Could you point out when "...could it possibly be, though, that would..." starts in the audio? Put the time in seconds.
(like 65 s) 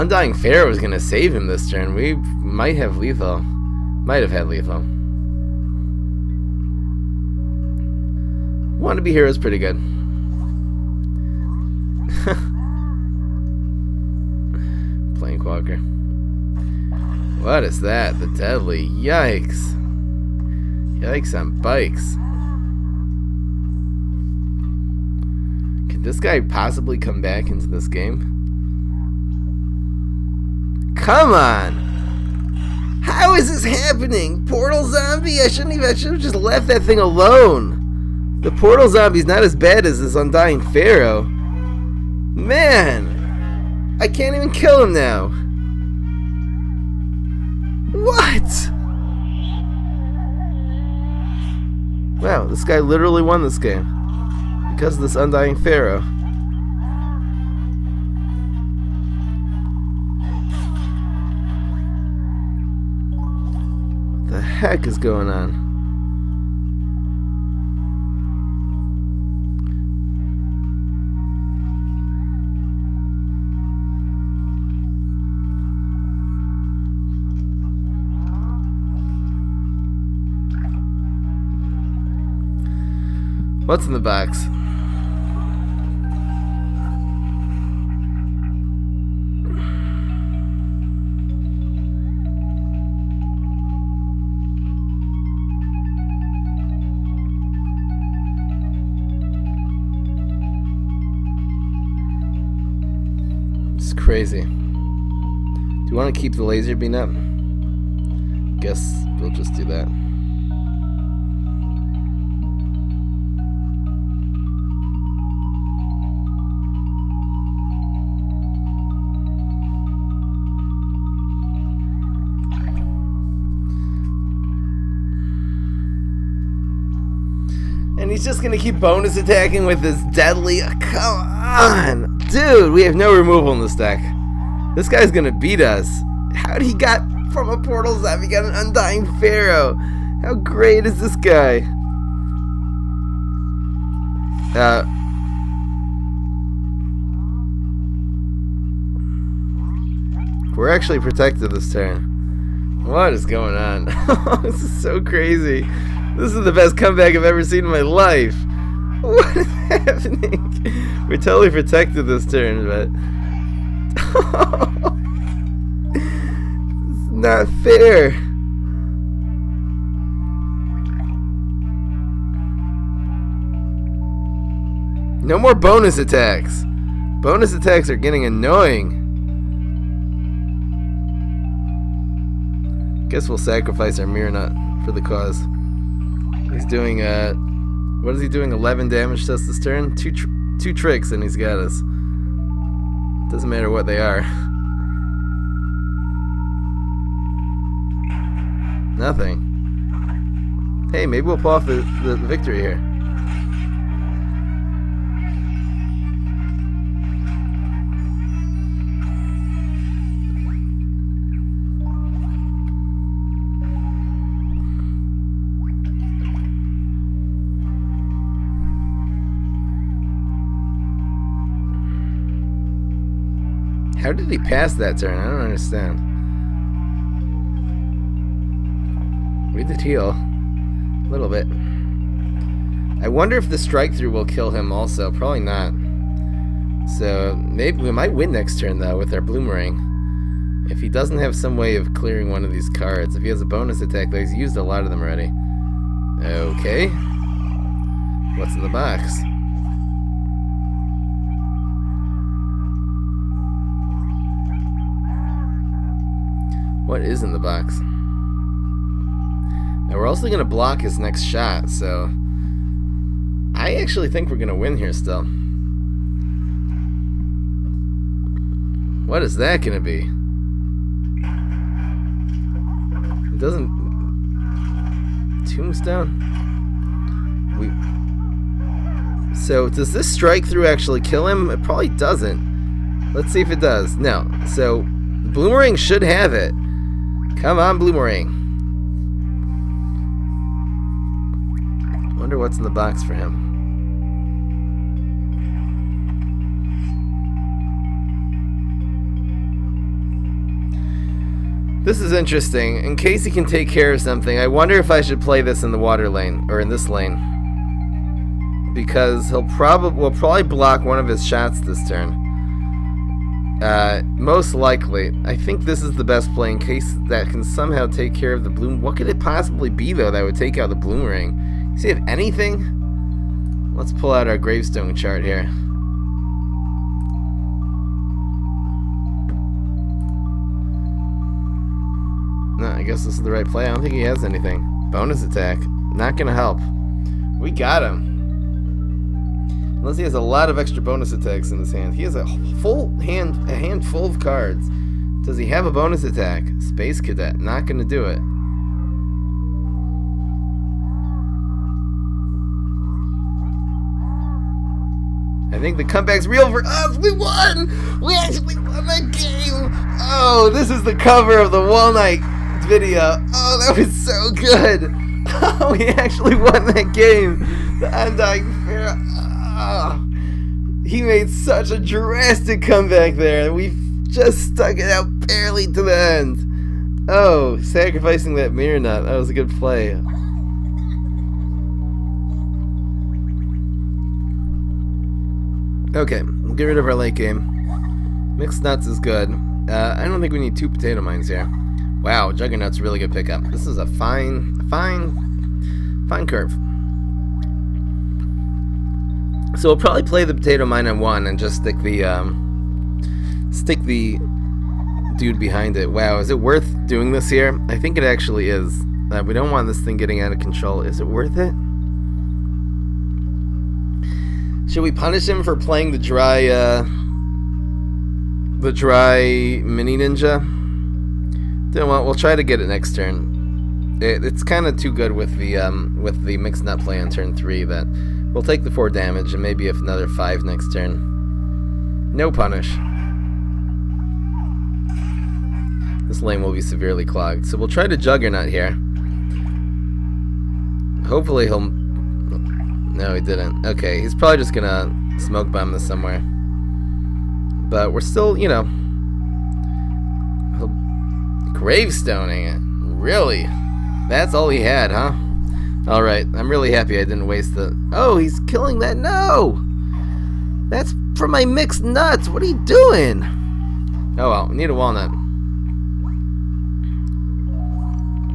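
318 s.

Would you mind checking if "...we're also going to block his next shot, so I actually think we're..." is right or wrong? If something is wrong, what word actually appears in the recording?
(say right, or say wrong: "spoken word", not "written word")
right.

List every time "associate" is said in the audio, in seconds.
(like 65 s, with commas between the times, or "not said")
not said.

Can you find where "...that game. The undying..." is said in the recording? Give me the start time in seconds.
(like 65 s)
366 s.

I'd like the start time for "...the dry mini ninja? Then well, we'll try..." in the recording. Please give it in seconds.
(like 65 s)
418 s.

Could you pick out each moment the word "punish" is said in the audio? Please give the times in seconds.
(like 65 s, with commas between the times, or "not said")
414 s, 432 s.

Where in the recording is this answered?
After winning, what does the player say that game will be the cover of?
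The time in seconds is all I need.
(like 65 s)
361 s.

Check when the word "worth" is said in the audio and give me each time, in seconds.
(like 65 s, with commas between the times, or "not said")
406 s, 411 s.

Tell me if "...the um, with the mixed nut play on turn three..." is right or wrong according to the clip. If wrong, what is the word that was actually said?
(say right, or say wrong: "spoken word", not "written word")
right.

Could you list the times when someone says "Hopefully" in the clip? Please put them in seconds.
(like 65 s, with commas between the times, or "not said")
441 s.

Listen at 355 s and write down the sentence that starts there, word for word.
I think the comeback's real for us.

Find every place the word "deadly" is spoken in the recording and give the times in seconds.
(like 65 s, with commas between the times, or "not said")
18 s, 130 s.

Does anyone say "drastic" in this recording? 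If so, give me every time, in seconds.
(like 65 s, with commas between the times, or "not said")
371 s.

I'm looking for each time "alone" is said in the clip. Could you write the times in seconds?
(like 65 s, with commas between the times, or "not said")
36 s.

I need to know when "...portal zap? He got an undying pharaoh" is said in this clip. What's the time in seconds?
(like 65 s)
137 s.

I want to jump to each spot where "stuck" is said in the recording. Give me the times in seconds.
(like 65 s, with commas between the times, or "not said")
374 s.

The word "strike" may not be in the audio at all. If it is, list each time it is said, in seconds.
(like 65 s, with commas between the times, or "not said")
233 s, 280 s.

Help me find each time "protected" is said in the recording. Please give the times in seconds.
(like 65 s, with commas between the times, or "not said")
150 s, 161 s.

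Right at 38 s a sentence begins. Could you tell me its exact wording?
The portal zombie's not as bad as this undying pharaoh.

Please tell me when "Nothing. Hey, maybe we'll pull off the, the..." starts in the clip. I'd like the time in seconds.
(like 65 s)
198 s.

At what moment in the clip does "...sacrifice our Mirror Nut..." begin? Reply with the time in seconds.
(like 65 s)
183 s.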